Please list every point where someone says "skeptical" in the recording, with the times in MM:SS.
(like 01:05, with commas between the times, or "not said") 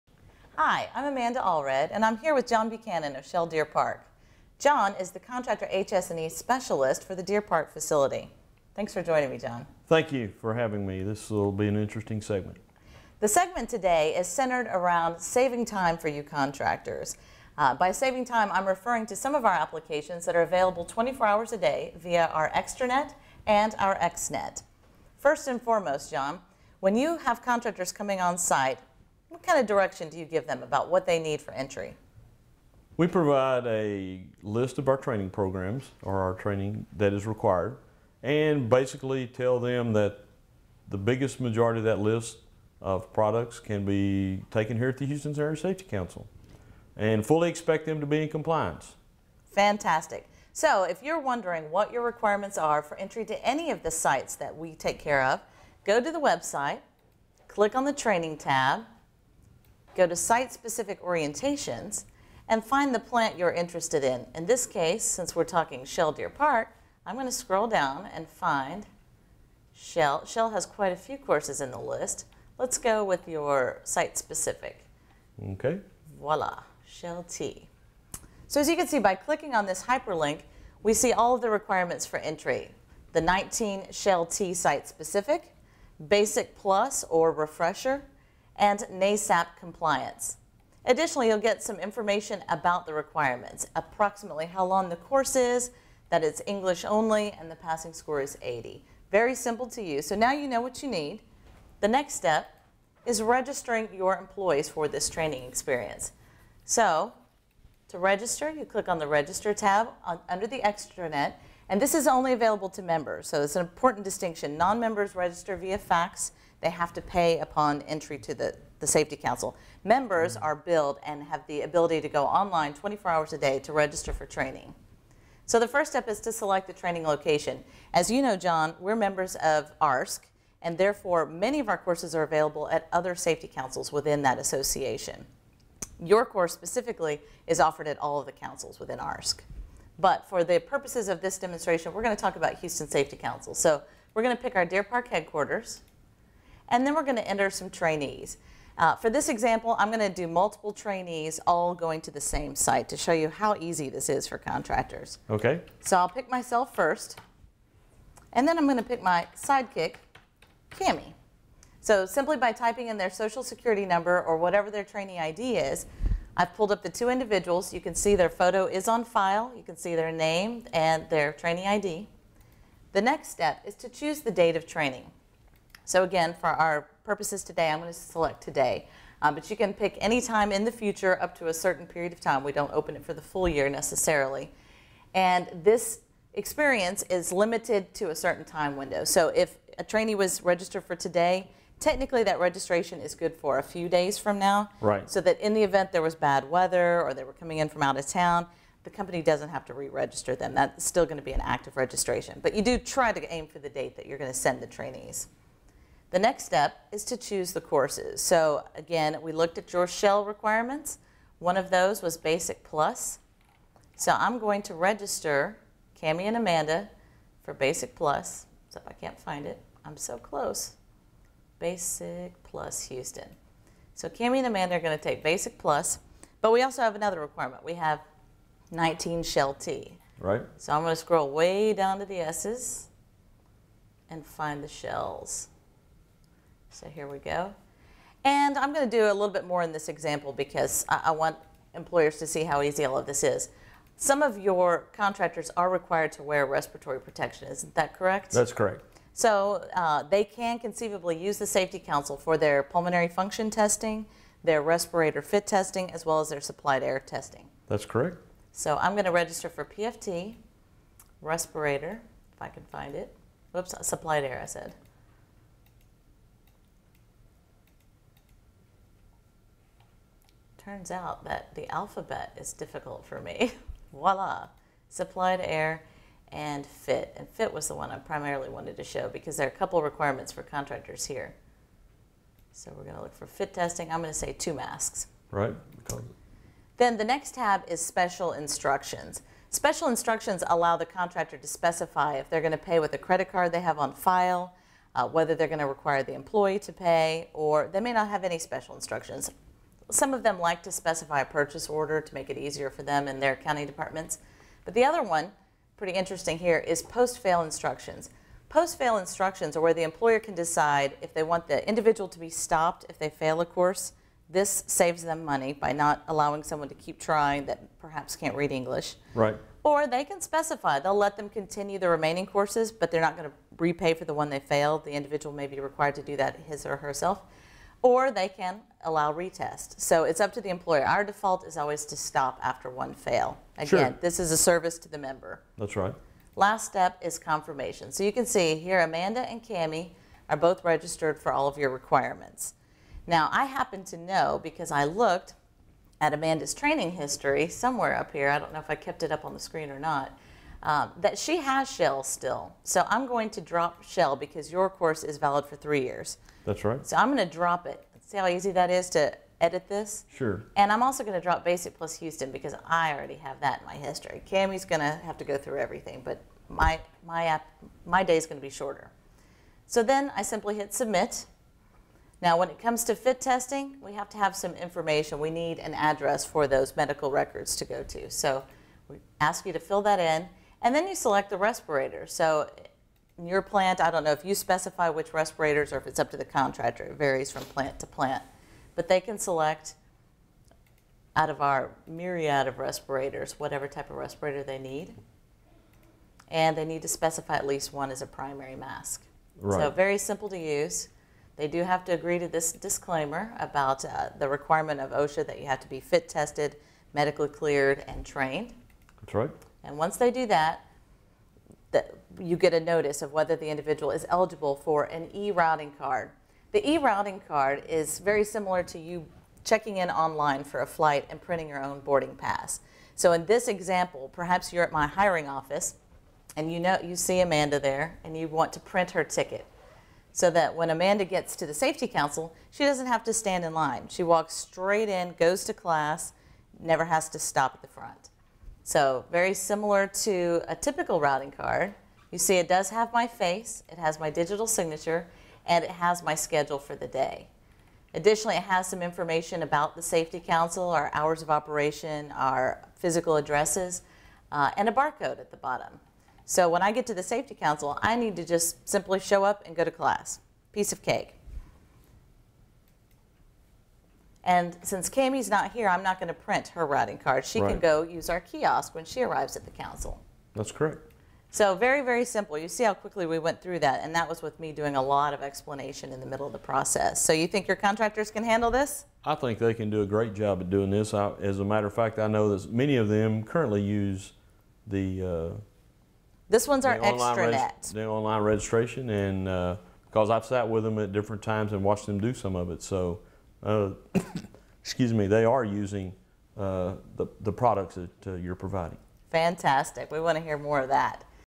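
not said.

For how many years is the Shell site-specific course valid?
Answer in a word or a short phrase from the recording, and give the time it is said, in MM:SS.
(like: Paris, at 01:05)
3, at 05:55.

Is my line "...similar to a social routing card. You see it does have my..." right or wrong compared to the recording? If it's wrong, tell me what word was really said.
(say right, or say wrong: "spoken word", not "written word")
wrong: "typical", not "social".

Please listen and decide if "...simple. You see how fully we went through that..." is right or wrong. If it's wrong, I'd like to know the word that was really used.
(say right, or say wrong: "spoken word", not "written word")
wrong: "quickly", not "fully".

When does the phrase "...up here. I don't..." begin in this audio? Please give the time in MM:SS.
05:47.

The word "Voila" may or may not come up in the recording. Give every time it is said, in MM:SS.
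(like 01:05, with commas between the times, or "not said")
01:16, 04:33.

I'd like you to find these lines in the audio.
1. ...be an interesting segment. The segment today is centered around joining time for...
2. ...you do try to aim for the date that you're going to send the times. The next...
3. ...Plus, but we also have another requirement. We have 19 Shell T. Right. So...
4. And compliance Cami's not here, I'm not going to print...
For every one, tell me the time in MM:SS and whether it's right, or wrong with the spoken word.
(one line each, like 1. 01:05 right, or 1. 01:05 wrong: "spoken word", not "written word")
1. 00:11 wrong: "saving", not "joining"
2. 03:22 wrong: "trainees", not "times"
3. 03:45 right
4. 07:44 wrong: "since", not "compliance".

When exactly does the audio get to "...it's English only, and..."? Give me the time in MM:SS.
01:36.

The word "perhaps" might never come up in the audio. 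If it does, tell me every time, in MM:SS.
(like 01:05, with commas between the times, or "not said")
05:17, 07:04.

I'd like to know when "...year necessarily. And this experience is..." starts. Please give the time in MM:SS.
03:03.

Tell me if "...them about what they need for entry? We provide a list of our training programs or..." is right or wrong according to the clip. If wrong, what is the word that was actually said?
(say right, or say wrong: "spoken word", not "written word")
right.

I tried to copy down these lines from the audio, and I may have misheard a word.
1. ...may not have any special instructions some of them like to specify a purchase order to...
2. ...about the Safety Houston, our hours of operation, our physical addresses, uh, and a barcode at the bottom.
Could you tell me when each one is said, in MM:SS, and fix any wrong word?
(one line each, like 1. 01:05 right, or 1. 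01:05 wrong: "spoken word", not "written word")
1. 04:57 right
2. 07:29 wrong: "Council", not "Houston".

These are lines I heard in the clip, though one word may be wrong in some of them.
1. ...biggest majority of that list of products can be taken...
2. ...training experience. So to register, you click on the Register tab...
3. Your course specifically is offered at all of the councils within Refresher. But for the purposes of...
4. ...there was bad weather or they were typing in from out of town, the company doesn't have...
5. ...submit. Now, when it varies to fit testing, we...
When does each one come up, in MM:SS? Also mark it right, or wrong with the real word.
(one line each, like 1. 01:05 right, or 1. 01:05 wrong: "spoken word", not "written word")
1. 00:40 right
2. 01:45 right
3. 02:15 wrong: "ARSC", not "Refresher"
4. 03:15 wrong: "coming", not "typing"
5. 06:10 wrong: "comes", not "varies".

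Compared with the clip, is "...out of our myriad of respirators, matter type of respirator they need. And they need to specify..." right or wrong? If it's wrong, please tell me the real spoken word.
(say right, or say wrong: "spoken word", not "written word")
wrong: "whatever", not "matter".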